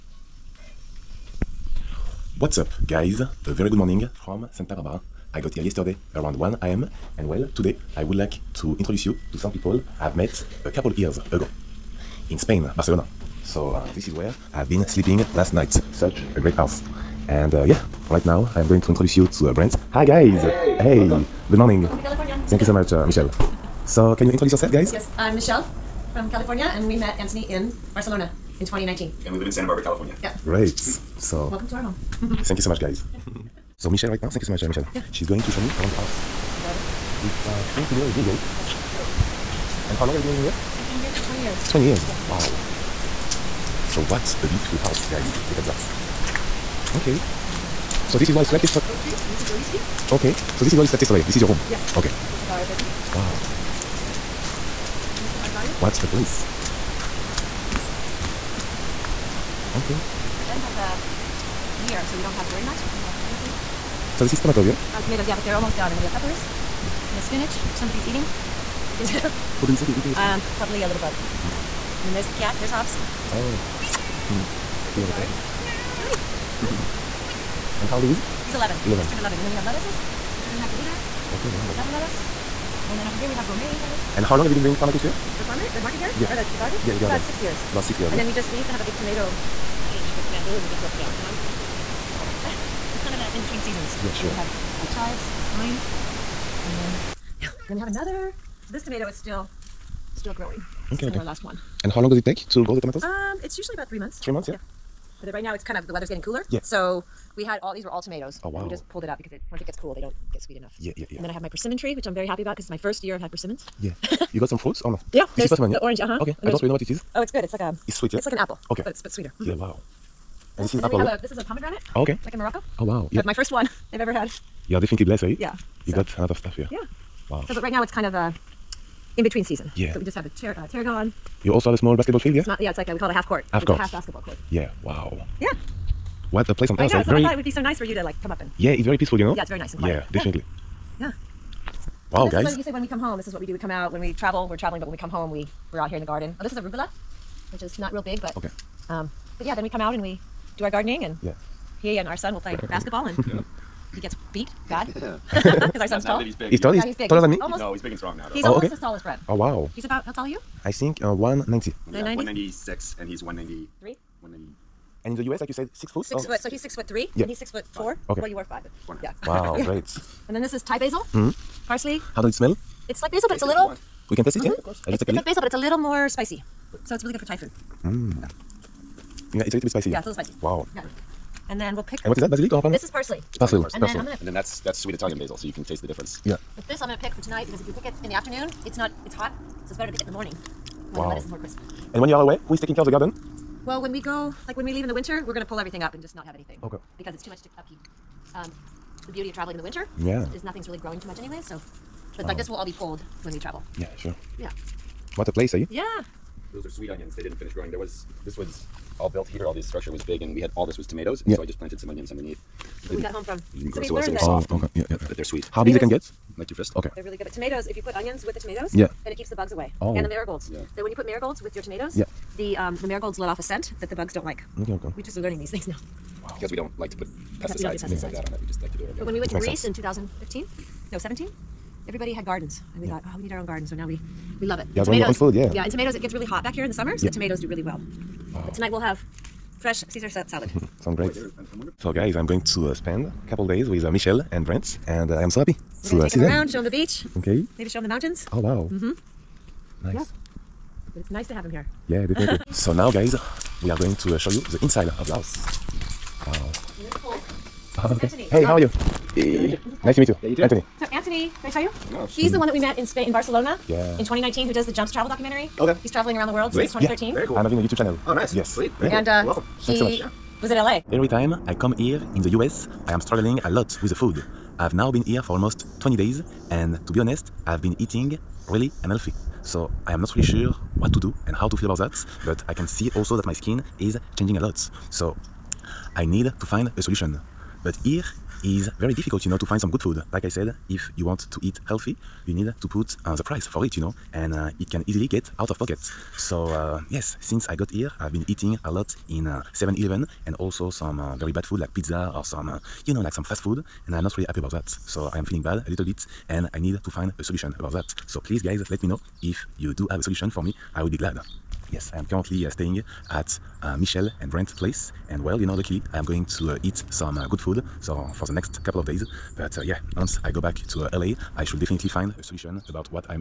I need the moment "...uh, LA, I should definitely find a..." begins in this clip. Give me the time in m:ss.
5:20.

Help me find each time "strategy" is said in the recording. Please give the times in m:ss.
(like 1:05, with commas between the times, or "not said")
not said.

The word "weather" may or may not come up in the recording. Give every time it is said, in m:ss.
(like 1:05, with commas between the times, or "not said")
1:45.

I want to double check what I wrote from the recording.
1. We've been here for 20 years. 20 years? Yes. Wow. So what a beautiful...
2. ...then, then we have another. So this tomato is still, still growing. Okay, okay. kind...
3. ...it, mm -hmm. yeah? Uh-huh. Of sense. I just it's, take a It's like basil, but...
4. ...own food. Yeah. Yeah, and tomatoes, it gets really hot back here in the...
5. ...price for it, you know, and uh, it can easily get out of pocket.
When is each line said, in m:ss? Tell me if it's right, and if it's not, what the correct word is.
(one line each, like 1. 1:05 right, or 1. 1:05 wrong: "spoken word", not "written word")
1. 0:40 right
2. 1:36 right
3. 2:54 wrong: "course", not "sense"
4. 3:55 right
5. 4:53 right.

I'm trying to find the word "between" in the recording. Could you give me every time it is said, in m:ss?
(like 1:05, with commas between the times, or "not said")
1:33, 2:09.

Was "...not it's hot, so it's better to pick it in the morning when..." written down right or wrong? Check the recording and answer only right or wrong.
right.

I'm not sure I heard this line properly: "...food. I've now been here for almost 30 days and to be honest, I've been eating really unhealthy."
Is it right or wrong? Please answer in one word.
wrong.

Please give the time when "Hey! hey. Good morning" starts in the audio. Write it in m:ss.
0:20.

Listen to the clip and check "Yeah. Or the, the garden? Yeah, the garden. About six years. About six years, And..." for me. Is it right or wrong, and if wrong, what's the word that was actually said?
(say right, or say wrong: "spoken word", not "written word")
right.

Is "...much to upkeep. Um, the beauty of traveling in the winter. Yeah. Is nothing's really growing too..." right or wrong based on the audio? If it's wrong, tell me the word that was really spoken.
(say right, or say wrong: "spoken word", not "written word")
right.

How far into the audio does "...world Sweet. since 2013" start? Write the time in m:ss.
4:26.